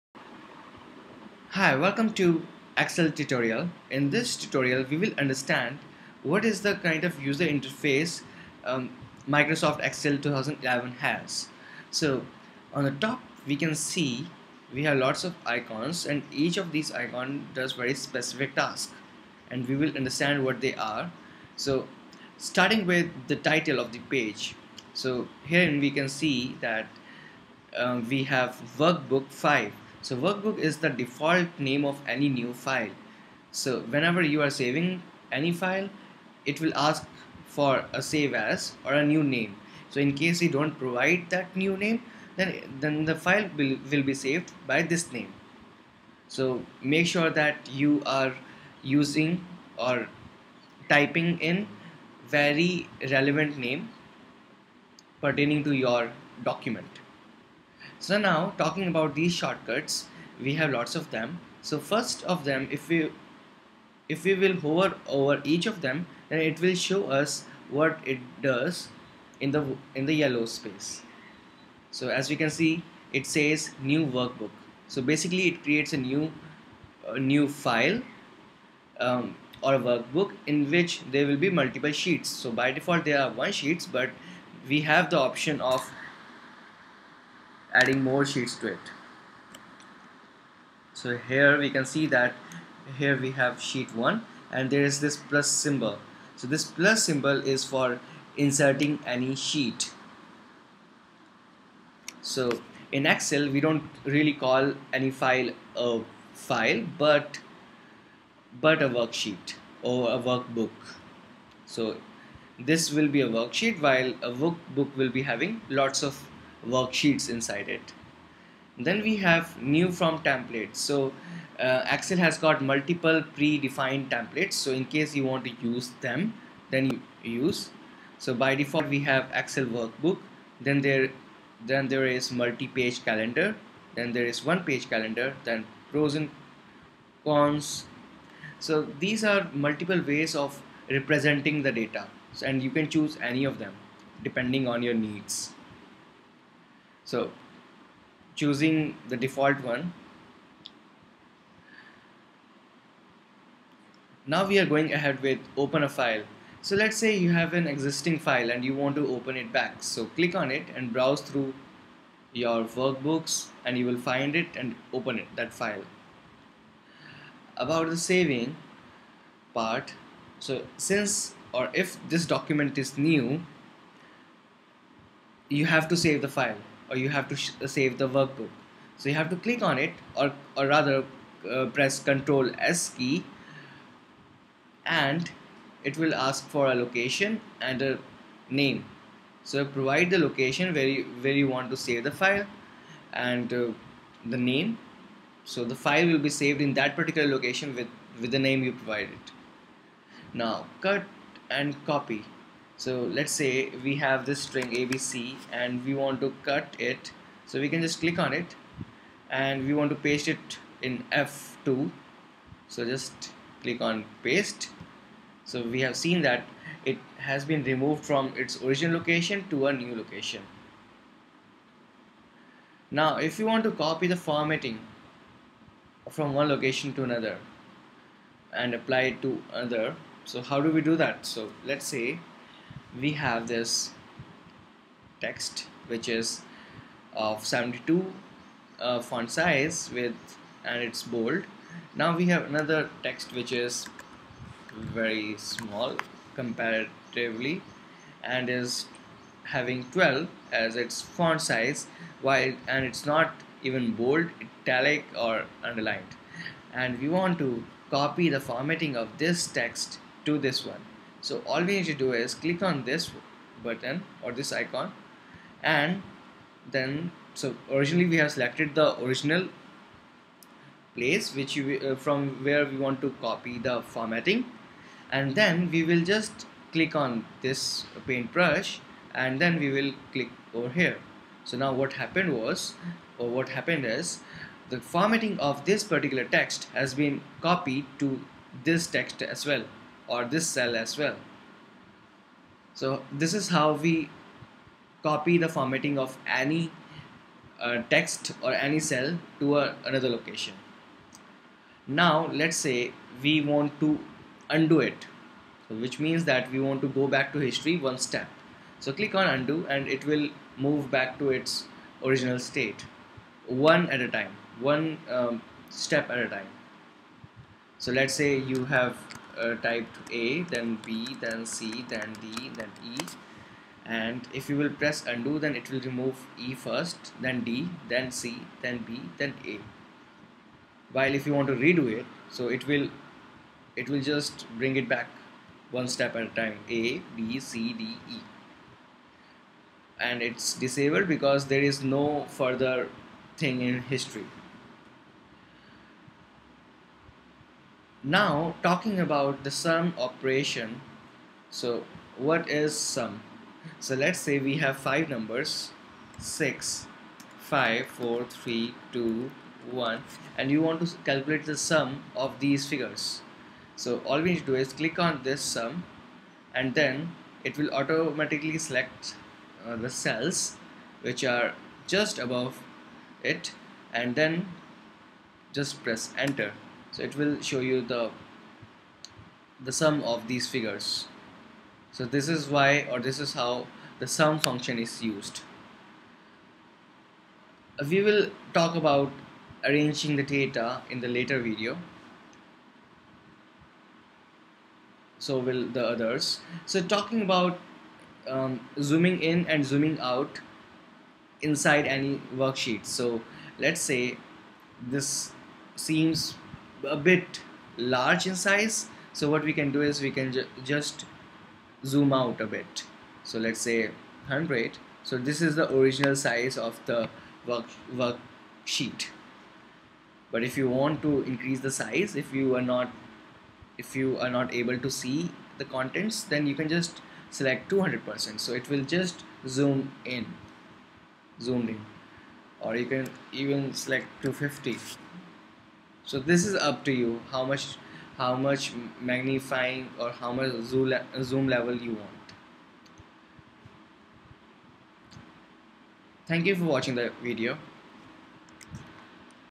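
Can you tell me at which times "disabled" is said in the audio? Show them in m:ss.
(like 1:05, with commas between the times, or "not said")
5:40.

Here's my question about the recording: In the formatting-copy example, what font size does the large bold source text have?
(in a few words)
72.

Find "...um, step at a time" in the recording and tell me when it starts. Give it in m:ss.
5:15.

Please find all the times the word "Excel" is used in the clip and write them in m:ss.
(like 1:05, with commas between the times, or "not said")
0:02, 0:09, 1:43, 2:01, 2:09.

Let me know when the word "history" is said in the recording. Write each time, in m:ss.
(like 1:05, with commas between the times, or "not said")
5:07, 5:43.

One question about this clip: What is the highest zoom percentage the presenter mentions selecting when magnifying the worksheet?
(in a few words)
250.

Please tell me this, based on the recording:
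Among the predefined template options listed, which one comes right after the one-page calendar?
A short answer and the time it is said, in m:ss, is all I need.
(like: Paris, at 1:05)
pros and cons, at 2:15.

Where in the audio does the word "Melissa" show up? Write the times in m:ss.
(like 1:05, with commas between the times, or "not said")
not said.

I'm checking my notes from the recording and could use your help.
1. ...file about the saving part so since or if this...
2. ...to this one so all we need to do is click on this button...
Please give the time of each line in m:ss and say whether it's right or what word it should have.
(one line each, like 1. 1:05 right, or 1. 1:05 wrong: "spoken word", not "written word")
1. 2:45 right
2. 4:20 right.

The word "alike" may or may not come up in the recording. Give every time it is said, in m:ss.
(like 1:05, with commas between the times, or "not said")
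not said.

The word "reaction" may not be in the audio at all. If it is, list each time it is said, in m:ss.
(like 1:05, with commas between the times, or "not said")
not said.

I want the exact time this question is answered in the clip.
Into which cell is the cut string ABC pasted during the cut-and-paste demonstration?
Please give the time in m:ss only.
3:31.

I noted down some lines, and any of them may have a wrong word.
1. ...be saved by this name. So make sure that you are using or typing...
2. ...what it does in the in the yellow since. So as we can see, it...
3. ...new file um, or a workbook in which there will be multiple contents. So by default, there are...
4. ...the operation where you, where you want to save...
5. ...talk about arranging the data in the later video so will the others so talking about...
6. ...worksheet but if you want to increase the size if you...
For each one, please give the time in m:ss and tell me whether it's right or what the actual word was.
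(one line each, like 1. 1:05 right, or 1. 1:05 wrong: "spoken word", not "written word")
1. 0:44 right
2. 1:07 wrong: "space", not "since"
3. 1:17 wrong: "sheets", not "contents"
4. 3:10 wrong: "location", not "operation"
5. 6:28 right
6. 6:58 right.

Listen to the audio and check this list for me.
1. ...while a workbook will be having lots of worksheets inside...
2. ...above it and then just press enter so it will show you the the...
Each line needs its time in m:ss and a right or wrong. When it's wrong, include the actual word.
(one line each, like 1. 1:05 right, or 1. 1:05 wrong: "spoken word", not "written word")
1. 1:53 right
2. 6:12 right.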